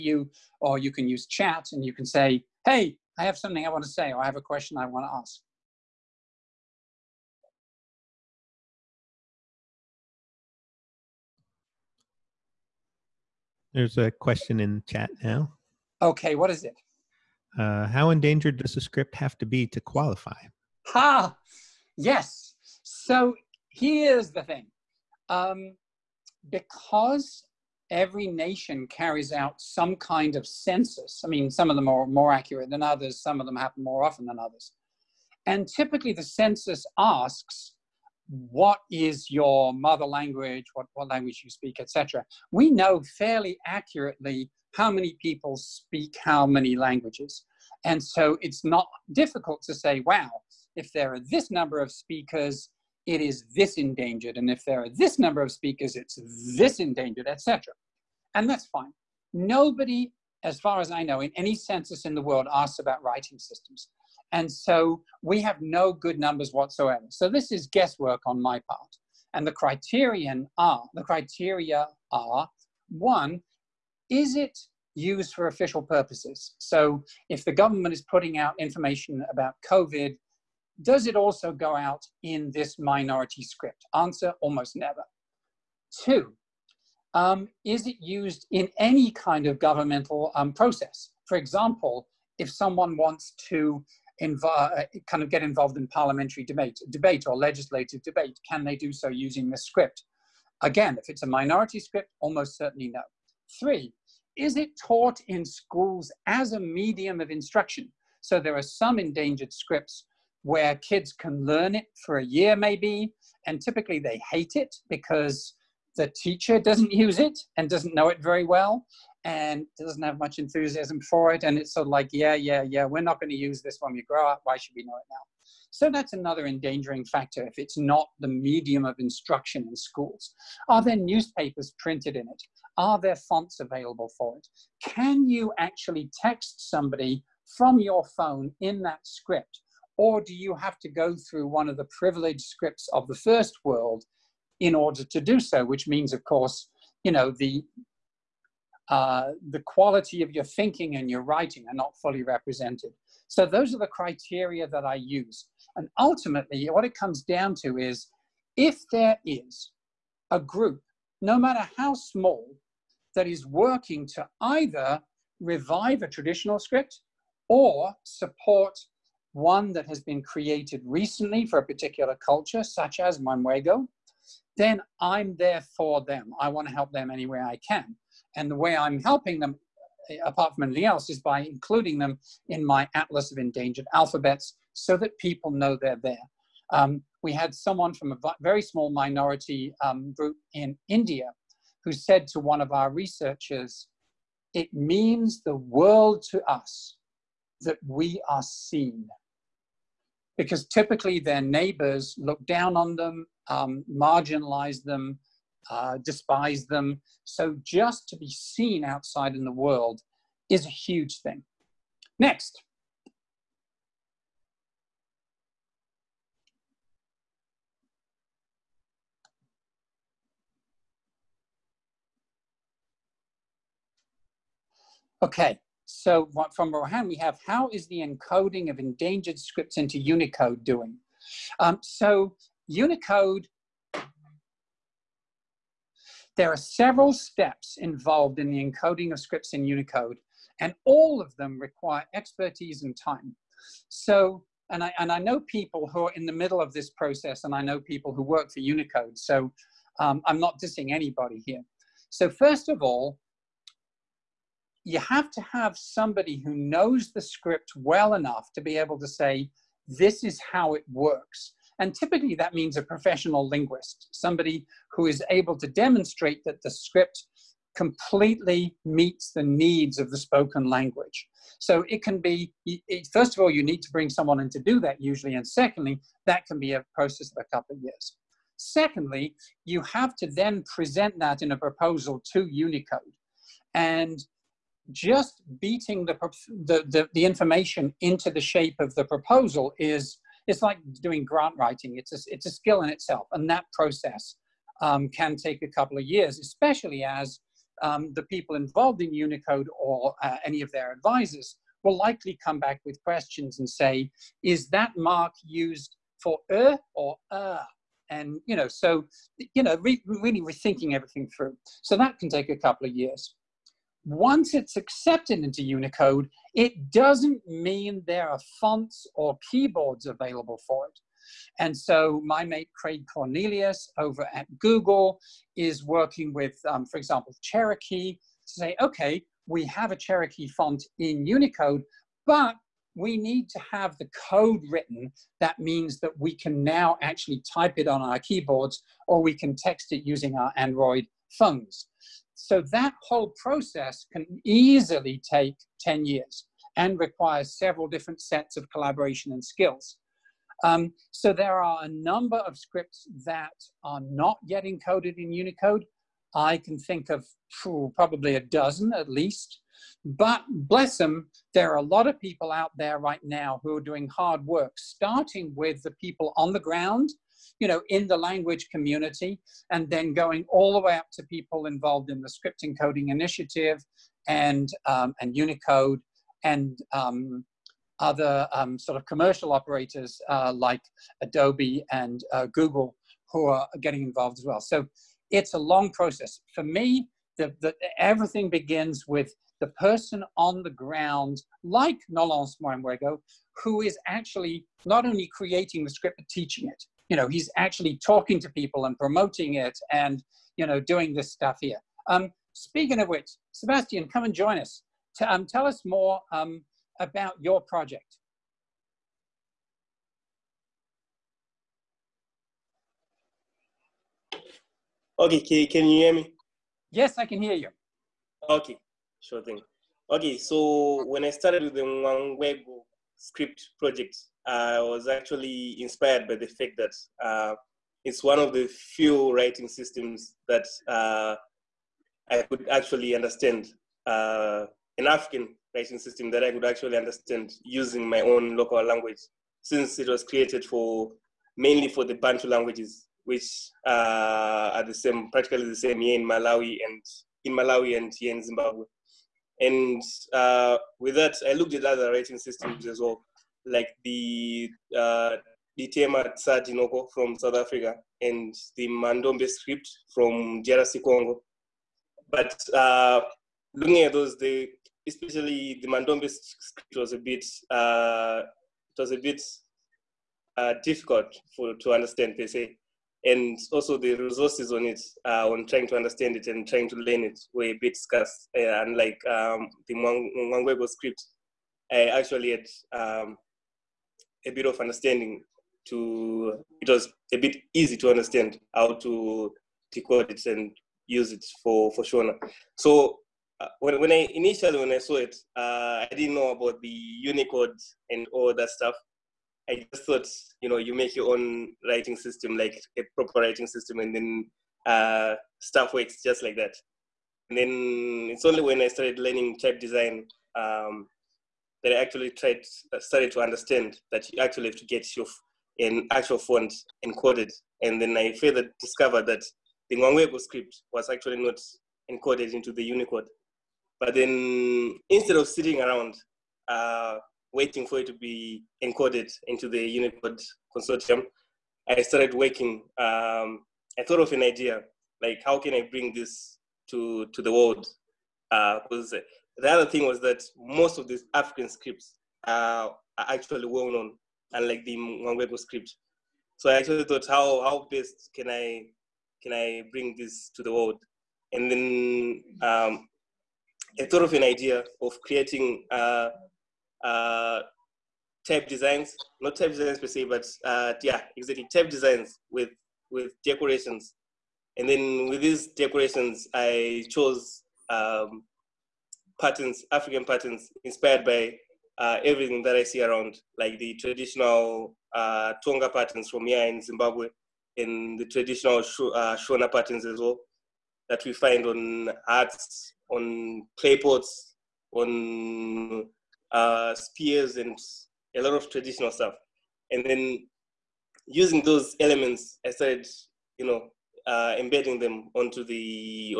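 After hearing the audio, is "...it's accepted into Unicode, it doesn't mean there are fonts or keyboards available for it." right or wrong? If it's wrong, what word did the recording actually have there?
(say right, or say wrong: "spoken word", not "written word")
right.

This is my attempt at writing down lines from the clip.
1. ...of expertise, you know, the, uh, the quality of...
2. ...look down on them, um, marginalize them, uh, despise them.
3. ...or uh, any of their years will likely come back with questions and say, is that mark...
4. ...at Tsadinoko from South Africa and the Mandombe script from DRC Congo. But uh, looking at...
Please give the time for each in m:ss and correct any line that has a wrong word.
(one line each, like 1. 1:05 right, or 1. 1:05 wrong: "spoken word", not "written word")
1. 2:26 wrong: "course", not "expertise"
2. 3:22 right
3. 4:59 wrong: "advisors", not "years"
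4. 7:35 right.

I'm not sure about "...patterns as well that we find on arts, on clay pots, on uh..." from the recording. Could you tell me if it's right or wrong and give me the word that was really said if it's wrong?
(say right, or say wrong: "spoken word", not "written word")
right.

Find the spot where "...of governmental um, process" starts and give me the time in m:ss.
1:29.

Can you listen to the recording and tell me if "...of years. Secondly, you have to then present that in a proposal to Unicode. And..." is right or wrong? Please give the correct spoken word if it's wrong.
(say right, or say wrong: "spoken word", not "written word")
right.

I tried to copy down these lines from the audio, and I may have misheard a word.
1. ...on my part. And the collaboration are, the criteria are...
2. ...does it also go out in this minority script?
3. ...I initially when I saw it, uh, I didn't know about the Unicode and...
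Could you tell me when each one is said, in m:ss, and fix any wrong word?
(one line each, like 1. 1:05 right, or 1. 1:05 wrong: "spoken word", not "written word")
1. 1:08 wrong: "criterion", not "collaboration"
2. 1:20 right
3. 8:14 right.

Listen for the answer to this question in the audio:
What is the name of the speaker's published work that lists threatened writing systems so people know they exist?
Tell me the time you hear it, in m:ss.
3:02.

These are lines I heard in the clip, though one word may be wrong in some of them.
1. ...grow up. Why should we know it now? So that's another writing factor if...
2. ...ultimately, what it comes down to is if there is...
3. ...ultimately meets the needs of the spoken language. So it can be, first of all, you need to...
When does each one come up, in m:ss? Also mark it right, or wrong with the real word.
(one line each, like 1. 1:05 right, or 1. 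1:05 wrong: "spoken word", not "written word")
1. 2:04 wrong: "endangering", not "writing"
2. 2:35 right
3. 4:27 wrong: "completely", not "ultimately".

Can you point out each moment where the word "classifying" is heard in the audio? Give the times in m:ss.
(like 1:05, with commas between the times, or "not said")
not said.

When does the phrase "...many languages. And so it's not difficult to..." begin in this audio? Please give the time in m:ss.
0:46.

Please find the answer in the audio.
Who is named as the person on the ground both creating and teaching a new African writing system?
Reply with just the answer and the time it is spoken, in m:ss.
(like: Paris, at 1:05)
Nolence Mwangwego, at 6:32.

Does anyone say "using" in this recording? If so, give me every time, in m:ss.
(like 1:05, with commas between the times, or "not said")
1:39, 5:40, 7:17, 9:51.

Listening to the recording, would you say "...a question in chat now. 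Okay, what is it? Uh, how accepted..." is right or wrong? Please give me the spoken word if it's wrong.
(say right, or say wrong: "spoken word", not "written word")
wrong: "endangered", not "accepted".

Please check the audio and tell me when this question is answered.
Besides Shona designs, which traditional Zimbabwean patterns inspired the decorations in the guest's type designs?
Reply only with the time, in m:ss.
9:35.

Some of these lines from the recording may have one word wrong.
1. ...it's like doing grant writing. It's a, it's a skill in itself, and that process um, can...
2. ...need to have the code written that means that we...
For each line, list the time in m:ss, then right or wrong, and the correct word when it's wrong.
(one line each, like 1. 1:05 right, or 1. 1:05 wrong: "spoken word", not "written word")
1. 4:50 right
2. 5:33 right.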